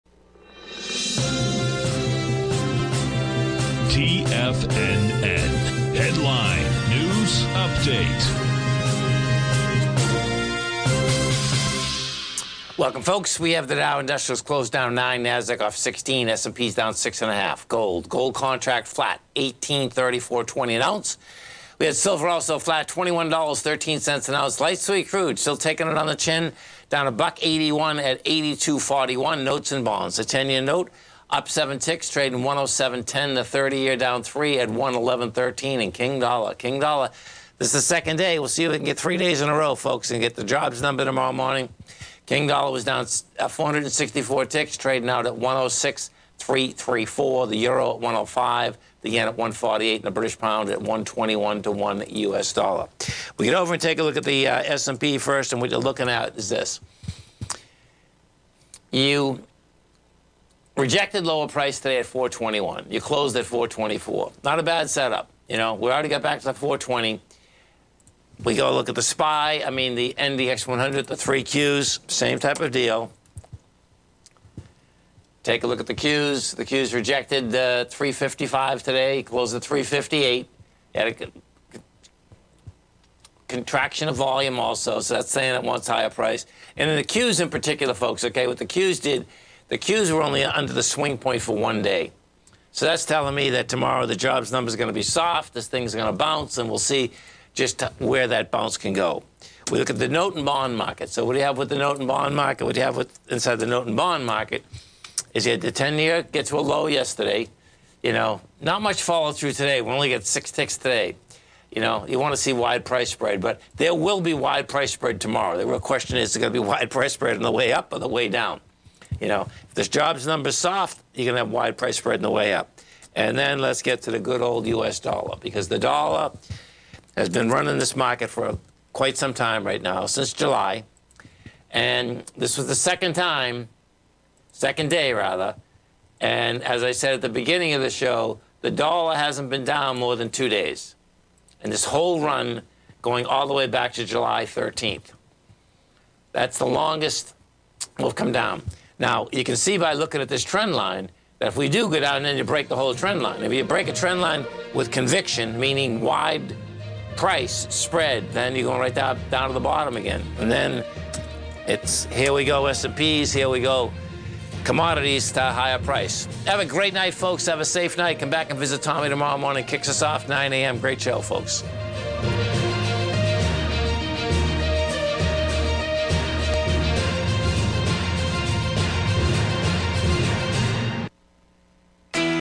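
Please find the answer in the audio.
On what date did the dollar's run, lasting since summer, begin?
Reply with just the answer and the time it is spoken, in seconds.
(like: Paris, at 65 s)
July 13th, at 144 s.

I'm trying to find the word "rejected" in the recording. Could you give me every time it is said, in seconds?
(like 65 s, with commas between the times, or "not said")
60 s, 76 s.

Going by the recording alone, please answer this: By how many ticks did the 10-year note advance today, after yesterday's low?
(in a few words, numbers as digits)
6.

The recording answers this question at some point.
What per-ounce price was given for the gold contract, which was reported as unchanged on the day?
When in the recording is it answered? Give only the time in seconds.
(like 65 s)
19 s.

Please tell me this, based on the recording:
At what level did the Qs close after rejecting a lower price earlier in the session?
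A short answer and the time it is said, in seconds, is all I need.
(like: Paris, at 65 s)
358, at 79 s.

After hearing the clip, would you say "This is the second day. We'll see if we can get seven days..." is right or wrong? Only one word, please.
wrong.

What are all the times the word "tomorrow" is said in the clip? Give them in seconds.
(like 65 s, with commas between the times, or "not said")
41 s, 93 s, 115 s, 169 s.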